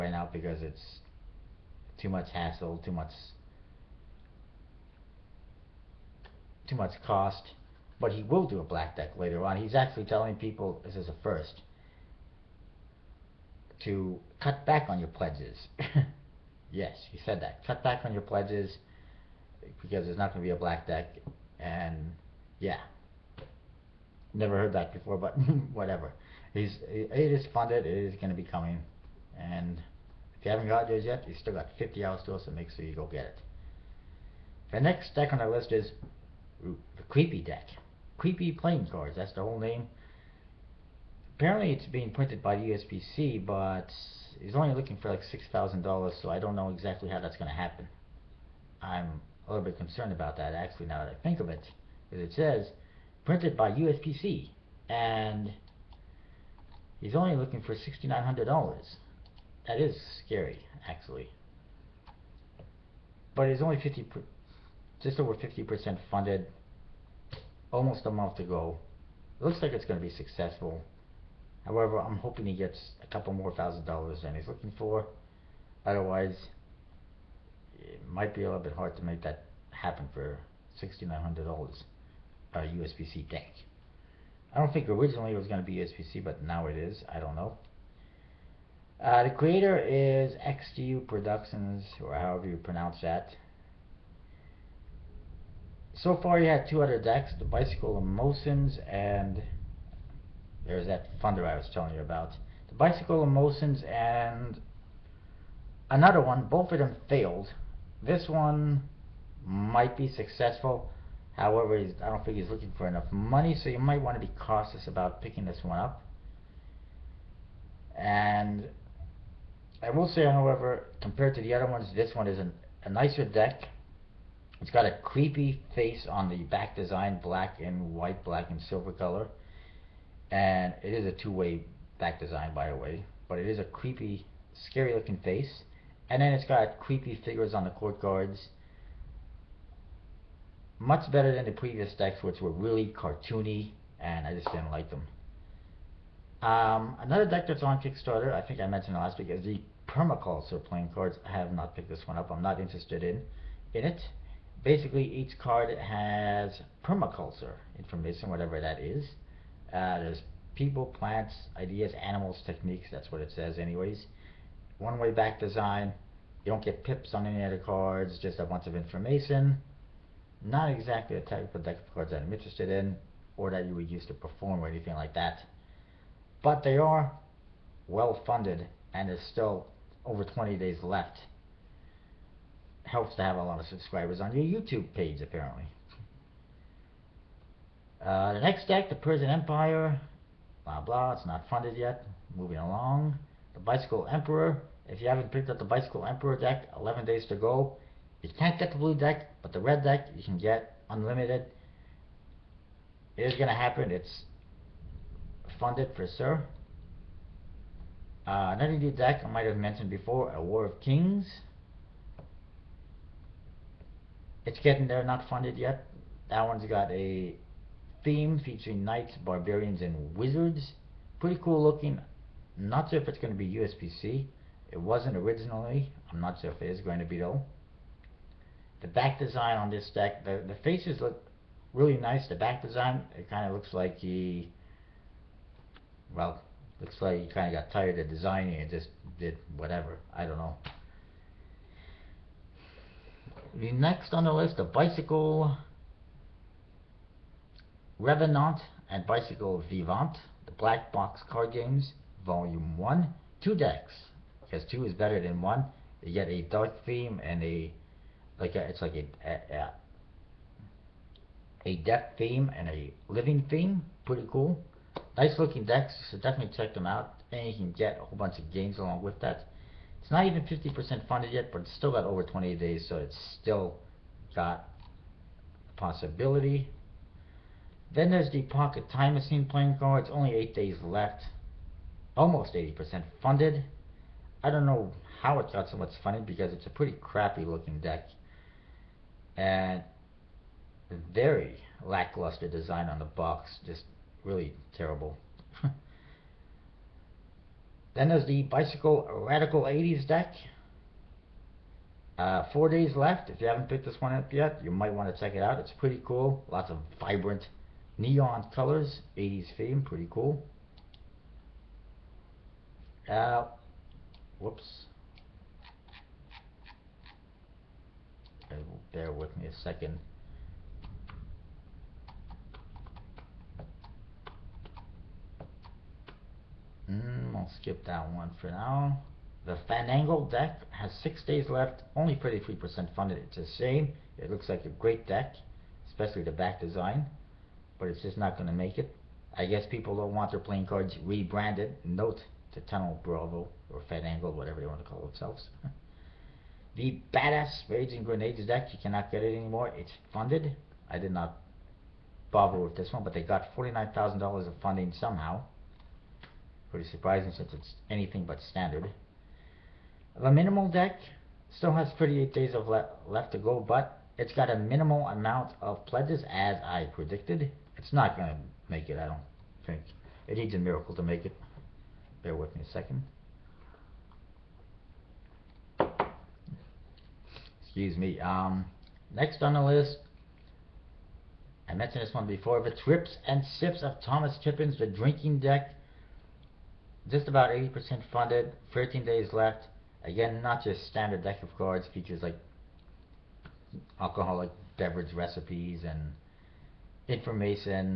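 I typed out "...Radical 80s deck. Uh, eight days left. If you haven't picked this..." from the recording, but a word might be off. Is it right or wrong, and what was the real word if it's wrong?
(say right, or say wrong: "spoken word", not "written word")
wrong: "four", not "eight".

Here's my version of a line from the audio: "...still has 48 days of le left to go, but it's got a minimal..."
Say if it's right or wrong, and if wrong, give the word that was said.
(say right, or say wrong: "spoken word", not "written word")
wrong: "38", not "48".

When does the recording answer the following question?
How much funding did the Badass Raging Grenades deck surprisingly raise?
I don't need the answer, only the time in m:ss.
5:53.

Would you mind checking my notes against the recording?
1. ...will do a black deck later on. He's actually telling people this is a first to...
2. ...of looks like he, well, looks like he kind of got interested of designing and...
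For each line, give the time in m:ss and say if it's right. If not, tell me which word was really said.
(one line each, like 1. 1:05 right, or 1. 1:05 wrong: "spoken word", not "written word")
1. 0:08 right
2. 3:53 wrong: "tired", not "interested".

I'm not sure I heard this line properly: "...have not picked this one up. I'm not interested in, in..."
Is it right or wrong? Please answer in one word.
right.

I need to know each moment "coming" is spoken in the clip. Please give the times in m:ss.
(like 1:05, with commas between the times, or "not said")
0:28.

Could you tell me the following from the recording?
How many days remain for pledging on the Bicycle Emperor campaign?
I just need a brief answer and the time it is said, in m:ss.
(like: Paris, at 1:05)
11, at 3:16.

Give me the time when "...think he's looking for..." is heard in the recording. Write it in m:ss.
1:52.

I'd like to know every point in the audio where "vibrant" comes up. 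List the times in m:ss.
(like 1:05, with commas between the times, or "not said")
5:06.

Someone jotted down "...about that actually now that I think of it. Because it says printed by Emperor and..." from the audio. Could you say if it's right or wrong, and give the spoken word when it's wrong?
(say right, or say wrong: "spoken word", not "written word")
wrong: "USPC", not "Emperor".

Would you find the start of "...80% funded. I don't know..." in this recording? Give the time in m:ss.
4:42.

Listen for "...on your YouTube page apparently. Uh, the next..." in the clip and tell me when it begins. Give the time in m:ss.
3:04.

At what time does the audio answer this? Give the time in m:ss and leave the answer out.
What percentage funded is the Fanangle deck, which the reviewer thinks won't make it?
5:32.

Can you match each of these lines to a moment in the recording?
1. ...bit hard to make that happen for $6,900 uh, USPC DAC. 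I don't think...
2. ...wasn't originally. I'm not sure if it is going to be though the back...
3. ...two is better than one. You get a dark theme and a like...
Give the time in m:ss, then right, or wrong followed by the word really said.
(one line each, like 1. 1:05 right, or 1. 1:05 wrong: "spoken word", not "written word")
1. 1:18 right
2. 3:44 right
3. 4:14 right.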